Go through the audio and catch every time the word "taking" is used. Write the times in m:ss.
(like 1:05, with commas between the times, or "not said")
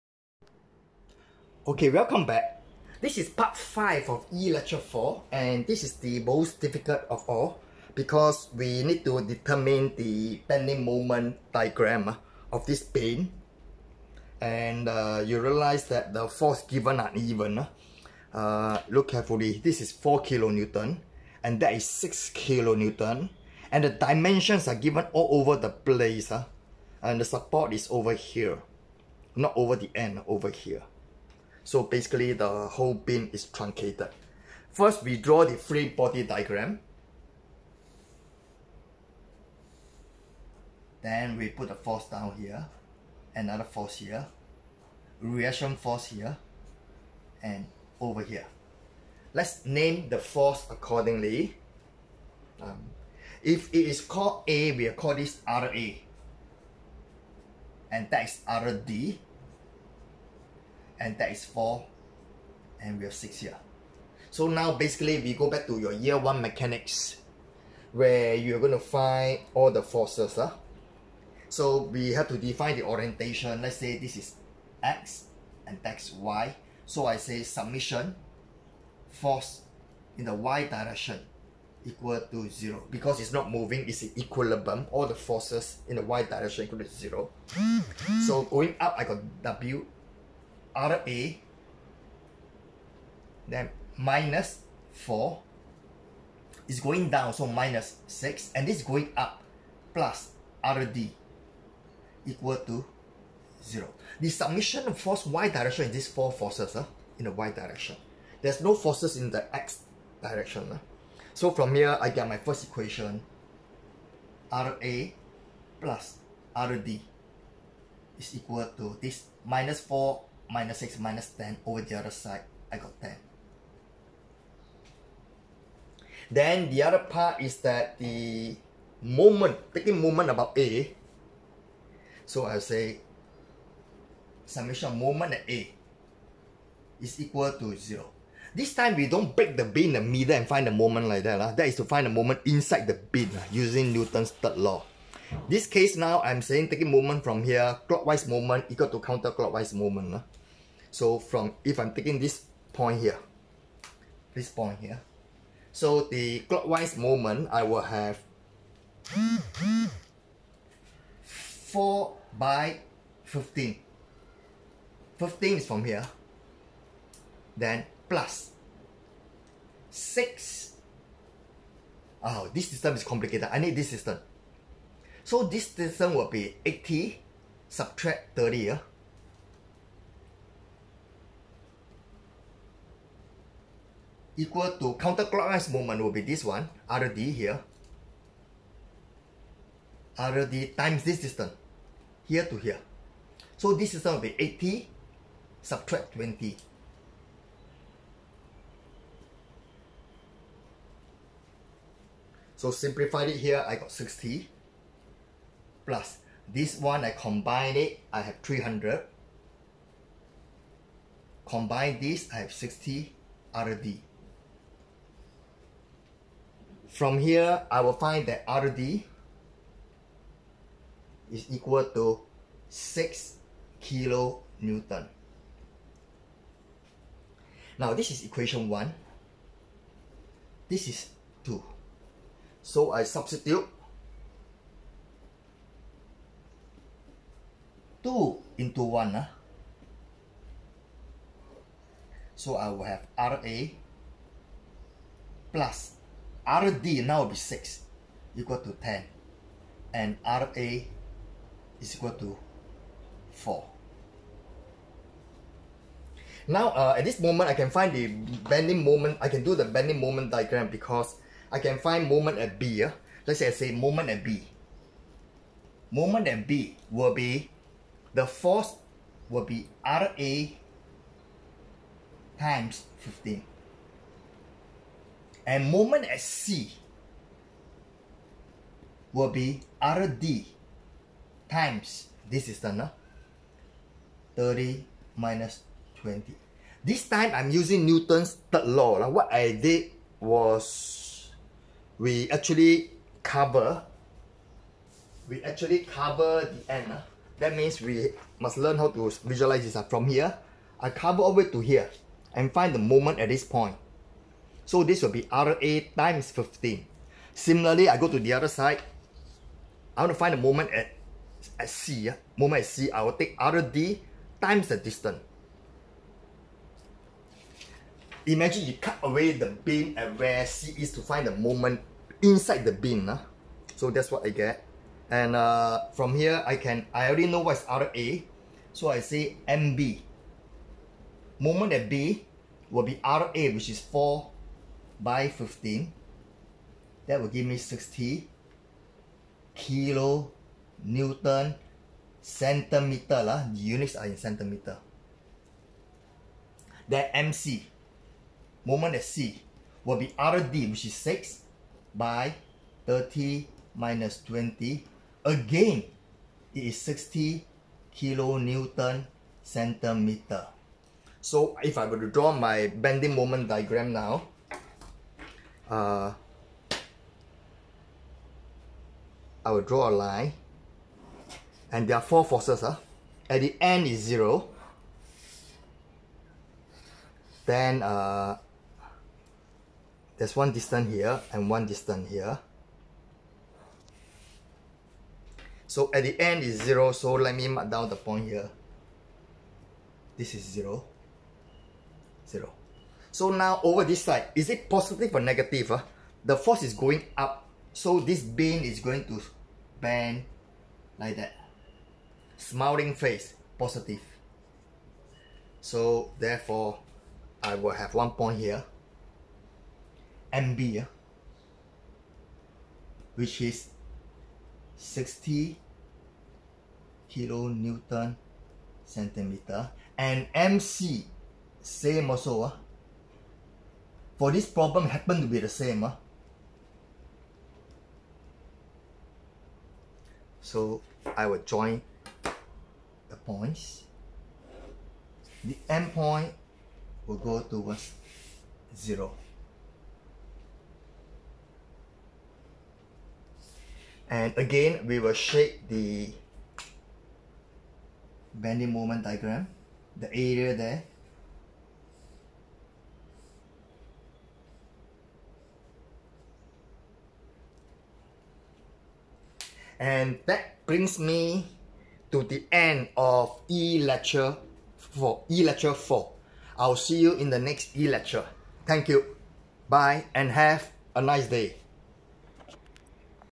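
2:09, 2:26, 2:31.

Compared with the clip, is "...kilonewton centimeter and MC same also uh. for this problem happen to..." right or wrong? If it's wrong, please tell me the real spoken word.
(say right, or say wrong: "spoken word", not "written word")
right.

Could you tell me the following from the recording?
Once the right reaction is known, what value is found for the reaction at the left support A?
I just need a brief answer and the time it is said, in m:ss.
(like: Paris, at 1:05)
4, at 4:10.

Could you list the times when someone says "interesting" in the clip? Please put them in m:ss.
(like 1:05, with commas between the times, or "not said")
not said.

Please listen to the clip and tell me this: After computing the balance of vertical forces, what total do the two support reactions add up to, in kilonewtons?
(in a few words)
10.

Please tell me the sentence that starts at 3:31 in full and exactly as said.
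Combine this, I have 60 RD.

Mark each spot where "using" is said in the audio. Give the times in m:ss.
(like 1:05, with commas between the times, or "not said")
2:23, 4:47.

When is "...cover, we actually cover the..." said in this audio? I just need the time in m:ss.
4:53.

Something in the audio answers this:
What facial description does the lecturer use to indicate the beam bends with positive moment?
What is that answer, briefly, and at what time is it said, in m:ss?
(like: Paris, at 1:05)
Smiling face, at 6:42.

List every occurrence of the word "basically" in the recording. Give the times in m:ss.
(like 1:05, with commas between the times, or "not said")
0:31, 1:04.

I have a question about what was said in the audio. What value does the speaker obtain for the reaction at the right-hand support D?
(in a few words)
6 kilonewton.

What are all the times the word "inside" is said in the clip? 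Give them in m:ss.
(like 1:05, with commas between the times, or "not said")
2:22, 5:22.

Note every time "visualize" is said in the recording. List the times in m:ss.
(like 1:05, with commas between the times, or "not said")
4:59.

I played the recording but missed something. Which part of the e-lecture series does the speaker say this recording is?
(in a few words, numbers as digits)
5.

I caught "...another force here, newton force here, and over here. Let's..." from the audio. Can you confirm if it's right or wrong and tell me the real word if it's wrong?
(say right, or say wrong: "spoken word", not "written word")
wrong: "reaction", not "newton".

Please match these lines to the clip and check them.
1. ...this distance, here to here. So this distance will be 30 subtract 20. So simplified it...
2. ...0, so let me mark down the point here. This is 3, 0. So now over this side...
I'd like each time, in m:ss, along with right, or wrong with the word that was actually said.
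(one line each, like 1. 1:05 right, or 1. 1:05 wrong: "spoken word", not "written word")
1. 3:11 wrong: "80", not "30"
2. 6:26 wrong: "0", not "3".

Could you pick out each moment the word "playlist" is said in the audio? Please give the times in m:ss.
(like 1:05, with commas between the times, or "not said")
not said.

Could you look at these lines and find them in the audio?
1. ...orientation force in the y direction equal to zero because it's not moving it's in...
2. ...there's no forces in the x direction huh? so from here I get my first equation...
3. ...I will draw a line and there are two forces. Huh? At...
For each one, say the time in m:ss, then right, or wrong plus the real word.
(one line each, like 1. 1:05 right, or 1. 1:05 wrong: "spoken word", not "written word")
1. 1:17 wrong: "summation", not "orientation"
2. 1:48 right
3. 6:09 wrong: "four", not "two".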